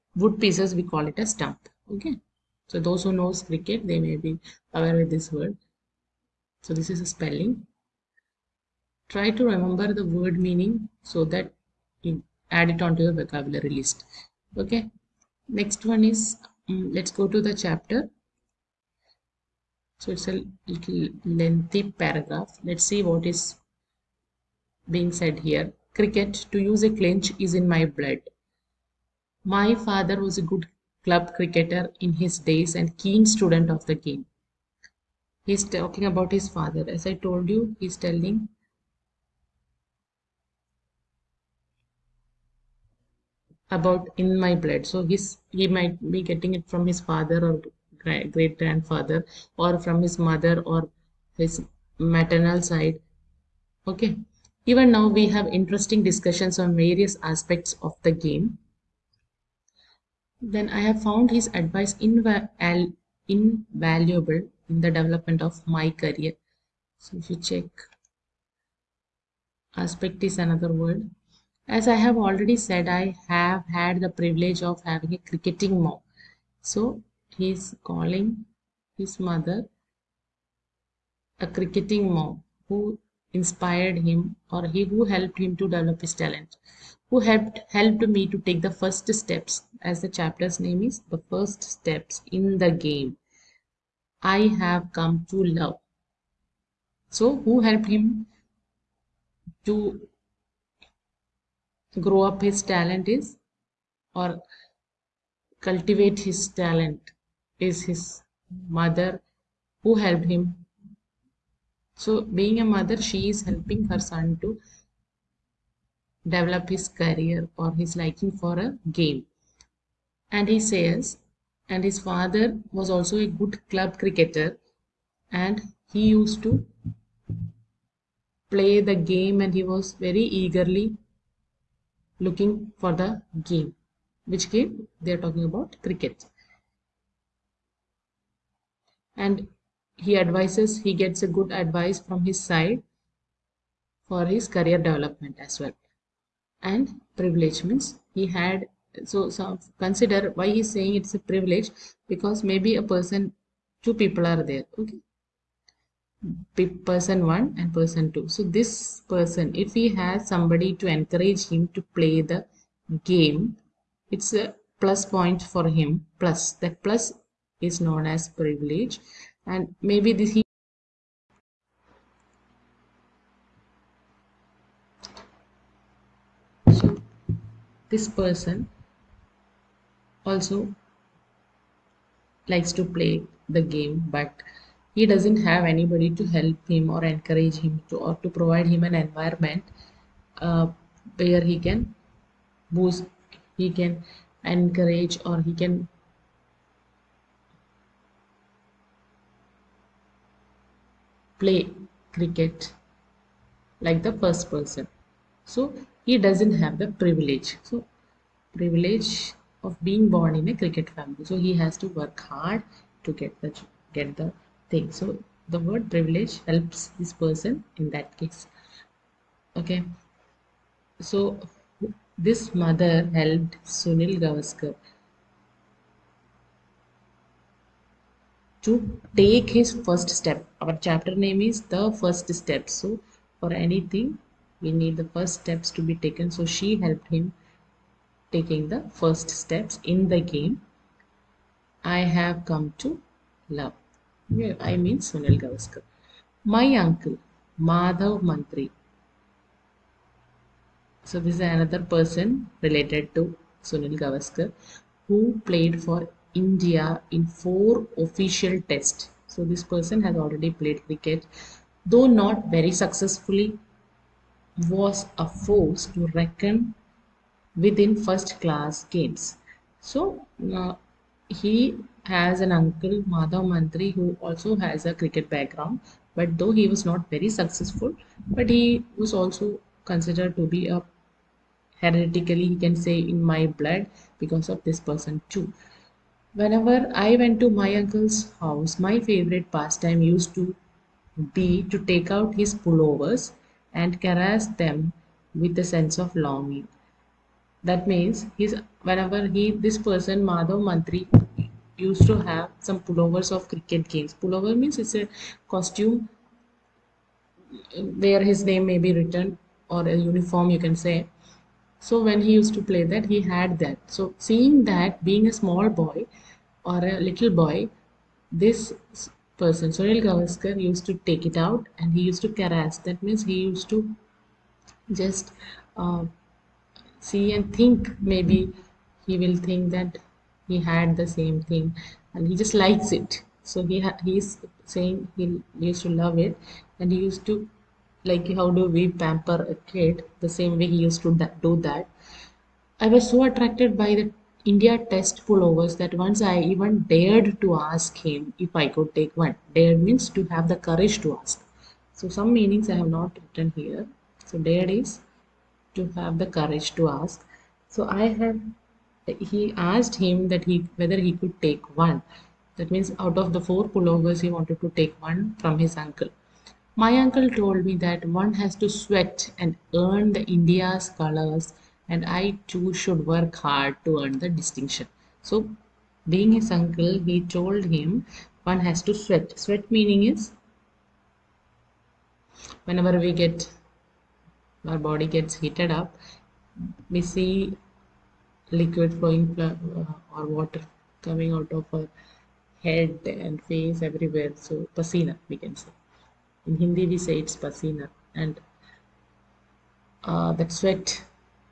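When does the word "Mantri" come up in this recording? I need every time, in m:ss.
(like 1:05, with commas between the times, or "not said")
4:08, 4:33, 5:00.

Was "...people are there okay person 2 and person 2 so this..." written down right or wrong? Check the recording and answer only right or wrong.
wrong.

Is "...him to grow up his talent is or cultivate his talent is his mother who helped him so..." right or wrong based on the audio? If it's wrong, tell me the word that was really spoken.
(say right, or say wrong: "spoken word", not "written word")
right.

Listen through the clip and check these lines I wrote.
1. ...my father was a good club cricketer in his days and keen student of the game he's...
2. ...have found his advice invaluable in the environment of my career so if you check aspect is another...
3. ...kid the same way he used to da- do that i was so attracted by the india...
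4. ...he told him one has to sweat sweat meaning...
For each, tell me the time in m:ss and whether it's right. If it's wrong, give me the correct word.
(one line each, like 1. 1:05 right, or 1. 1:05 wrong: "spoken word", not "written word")
1. 0:29 right
2. 1:00 wrong: "development", not "environment"
3. 5:39 right
4. 6:17 right.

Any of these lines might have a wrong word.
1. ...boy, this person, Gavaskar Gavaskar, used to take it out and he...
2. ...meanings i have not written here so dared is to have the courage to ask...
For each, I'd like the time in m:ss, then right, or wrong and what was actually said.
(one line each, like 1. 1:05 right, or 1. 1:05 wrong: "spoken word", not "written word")
1. 5:17 wrong: "Sunil", not "Gavaskar"
2. 5:52 right.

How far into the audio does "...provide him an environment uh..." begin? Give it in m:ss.
3:08.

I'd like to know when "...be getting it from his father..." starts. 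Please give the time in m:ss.
0:46.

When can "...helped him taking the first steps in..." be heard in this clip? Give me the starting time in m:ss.
3:56.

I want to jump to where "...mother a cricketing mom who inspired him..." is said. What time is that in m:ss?
1:19.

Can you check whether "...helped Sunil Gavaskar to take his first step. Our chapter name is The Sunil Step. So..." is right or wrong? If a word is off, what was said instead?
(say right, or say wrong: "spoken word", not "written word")
wrong: "First", not "Sunil".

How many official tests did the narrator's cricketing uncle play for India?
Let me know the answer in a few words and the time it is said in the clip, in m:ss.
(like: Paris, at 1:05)
4, at 4:17.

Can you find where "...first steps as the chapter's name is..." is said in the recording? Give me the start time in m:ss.
1:28.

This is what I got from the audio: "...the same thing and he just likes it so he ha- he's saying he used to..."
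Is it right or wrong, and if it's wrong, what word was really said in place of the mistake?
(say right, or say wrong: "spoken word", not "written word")
right.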